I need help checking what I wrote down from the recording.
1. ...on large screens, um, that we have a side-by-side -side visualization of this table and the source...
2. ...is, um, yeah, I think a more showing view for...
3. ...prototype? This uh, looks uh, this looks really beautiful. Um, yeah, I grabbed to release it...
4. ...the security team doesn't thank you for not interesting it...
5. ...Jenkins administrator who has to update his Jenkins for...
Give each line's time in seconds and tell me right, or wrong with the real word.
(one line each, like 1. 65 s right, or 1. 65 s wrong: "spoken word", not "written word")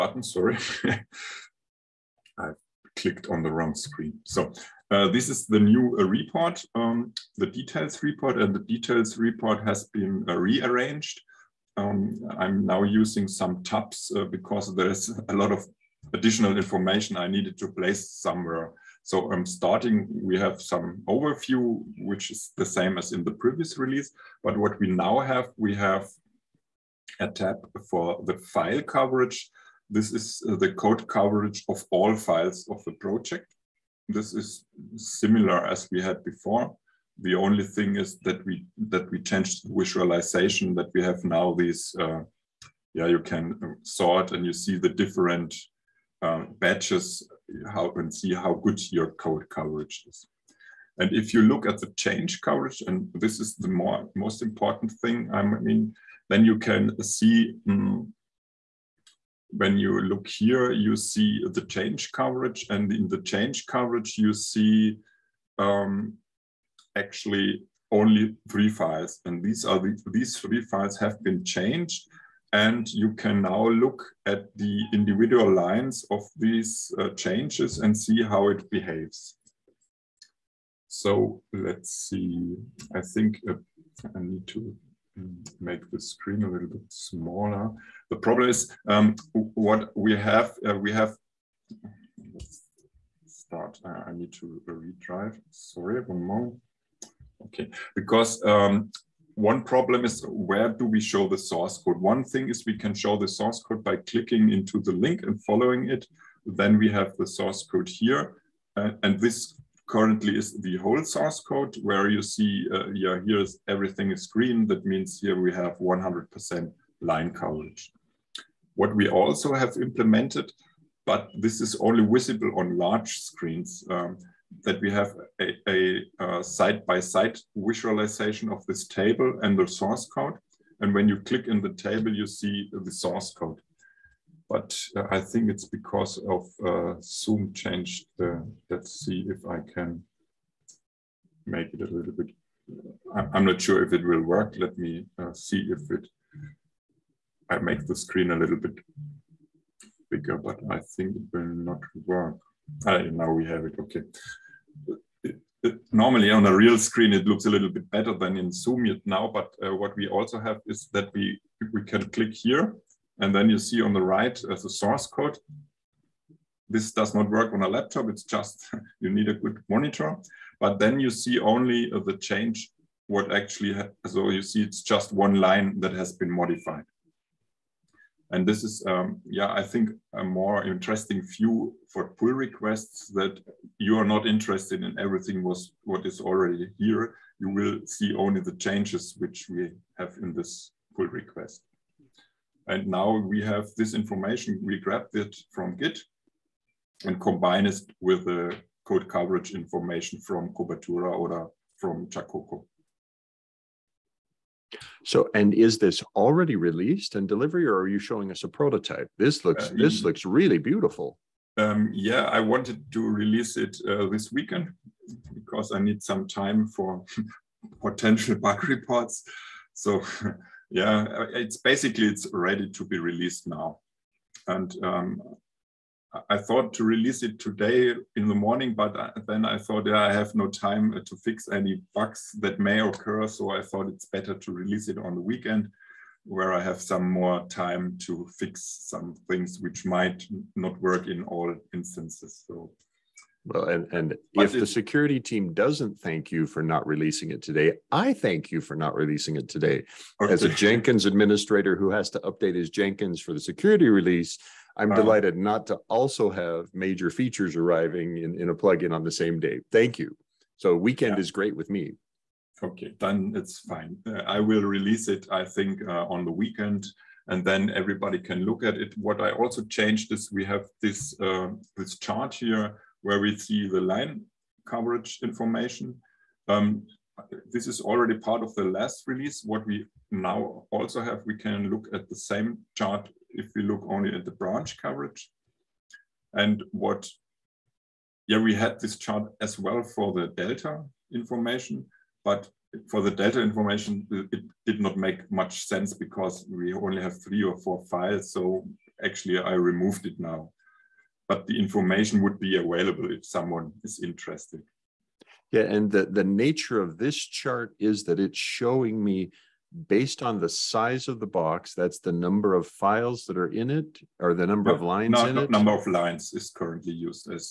1. 122 s right
2. 178 s wrong: "interesting", not "showing"
3. 208 s wrong: "wanted", not "grabbed"
4. 244 s wrong: "releasing", not "interesting"
5. 250 s right.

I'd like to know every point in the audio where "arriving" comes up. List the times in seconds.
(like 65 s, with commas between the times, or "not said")
257 s.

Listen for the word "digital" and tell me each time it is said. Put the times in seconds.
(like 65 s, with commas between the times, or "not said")
not said.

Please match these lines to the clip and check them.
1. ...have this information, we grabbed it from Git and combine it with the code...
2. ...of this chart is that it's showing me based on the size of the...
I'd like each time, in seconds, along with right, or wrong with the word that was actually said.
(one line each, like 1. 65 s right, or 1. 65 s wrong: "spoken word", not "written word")
1. 193 s right
2. 306 s right.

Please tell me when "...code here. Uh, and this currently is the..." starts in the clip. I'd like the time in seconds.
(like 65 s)
107 s.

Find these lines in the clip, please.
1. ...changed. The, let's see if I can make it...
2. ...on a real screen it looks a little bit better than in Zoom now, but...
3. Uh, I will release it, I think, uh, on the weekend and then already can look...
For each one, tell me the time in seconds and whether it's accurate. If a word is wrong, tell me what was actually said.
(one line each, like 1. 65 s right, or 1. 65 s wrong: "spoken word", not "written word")
1. 137 s right
2. 156 s right
3. 264 s wrong: "everybody", not "already".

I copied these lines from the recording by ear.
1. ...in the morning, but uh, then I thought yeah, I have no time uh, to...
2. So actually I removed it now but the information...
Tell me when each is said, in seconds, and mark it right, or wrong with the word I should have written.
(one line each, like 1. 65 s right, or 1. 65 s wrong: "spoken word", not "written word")
1. 228 s right
2. 298 s right.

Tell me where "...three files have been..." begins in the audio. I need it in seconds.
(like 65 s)
70 s.